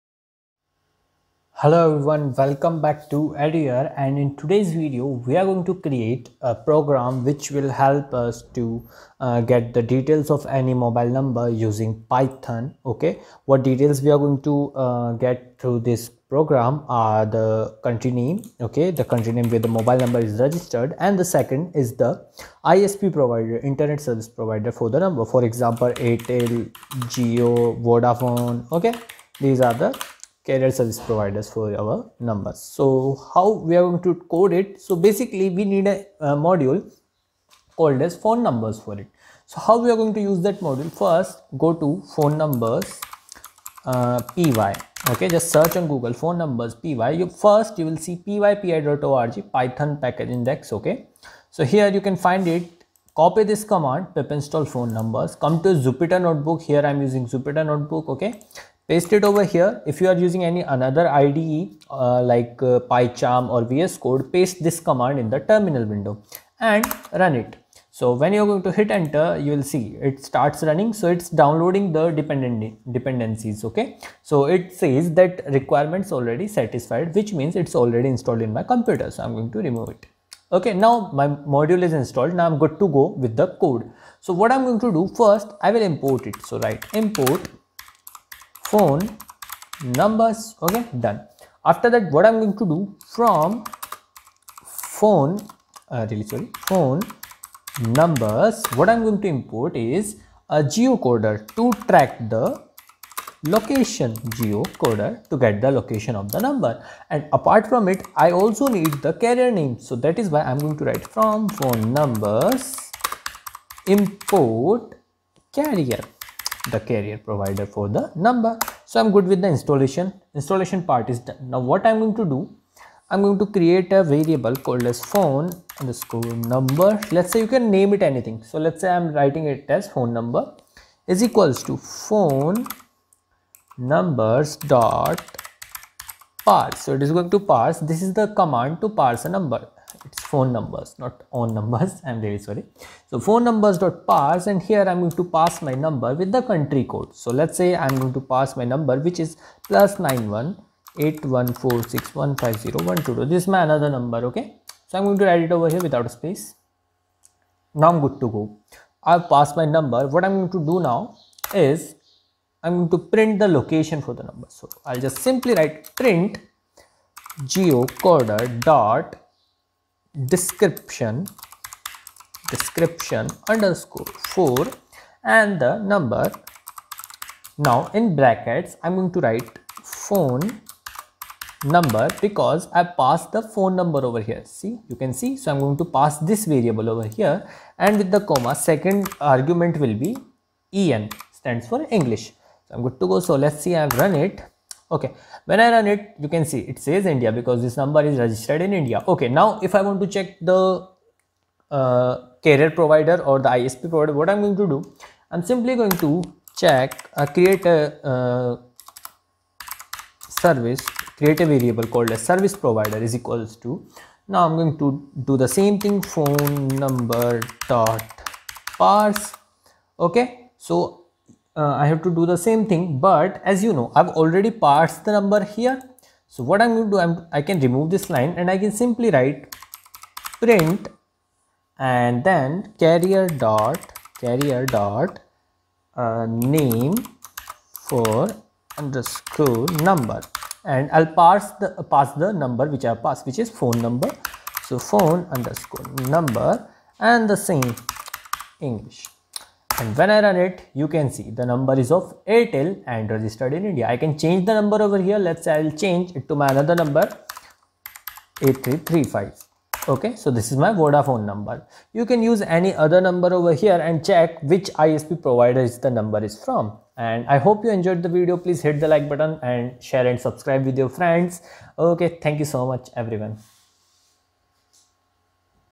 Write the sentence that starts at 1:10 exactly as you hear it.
So it's downloading the dependent dependencies.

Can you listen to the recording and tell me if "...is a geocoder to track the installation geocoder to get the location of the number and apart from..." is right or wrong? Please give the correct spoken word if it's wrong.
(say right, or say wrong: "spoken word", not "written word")
wrong: "location", not "installation".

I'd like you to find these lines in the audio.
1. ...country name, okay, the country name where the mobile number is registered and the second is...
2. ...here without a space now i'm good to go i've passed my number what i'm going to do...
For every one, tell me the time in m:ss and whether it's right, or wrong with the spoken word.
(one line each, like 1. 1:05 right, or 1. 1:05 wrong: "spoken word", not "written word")
1. 0:17 right
2. 2:35 right.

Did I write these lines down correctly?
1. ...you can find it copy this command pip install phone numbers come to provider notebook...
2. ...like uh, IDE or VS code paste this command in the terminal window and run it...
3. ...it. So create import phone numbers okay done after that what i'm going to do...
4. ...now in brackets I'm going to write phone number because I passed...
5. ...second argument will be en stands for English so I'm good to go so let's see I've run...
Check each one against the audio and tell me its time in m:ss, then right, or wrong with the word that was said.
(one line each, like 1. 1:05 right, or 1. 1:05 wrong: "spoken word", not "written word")
1. 0:51 wrong: "jupyter", not "provider"
2. 1:02 wrong: "PyCharm", not "IDE"
3. 1:26 wrong: "write", not "create"
4. 2:57 right
5. 3:08 right.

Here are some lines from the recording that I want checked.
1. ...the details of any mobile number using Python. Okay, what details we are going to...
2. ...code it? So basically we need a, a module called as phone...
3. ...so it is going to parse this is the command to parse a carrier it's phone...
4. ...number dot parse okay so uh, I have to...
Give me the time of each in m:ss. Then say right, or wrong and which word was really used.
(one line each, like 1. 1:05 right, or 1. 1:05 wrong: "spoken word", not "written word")
1. 0:09 right
2. 0:34 right
3. 2:16 wrong: "number", not "carrier"
4. 3:36 right.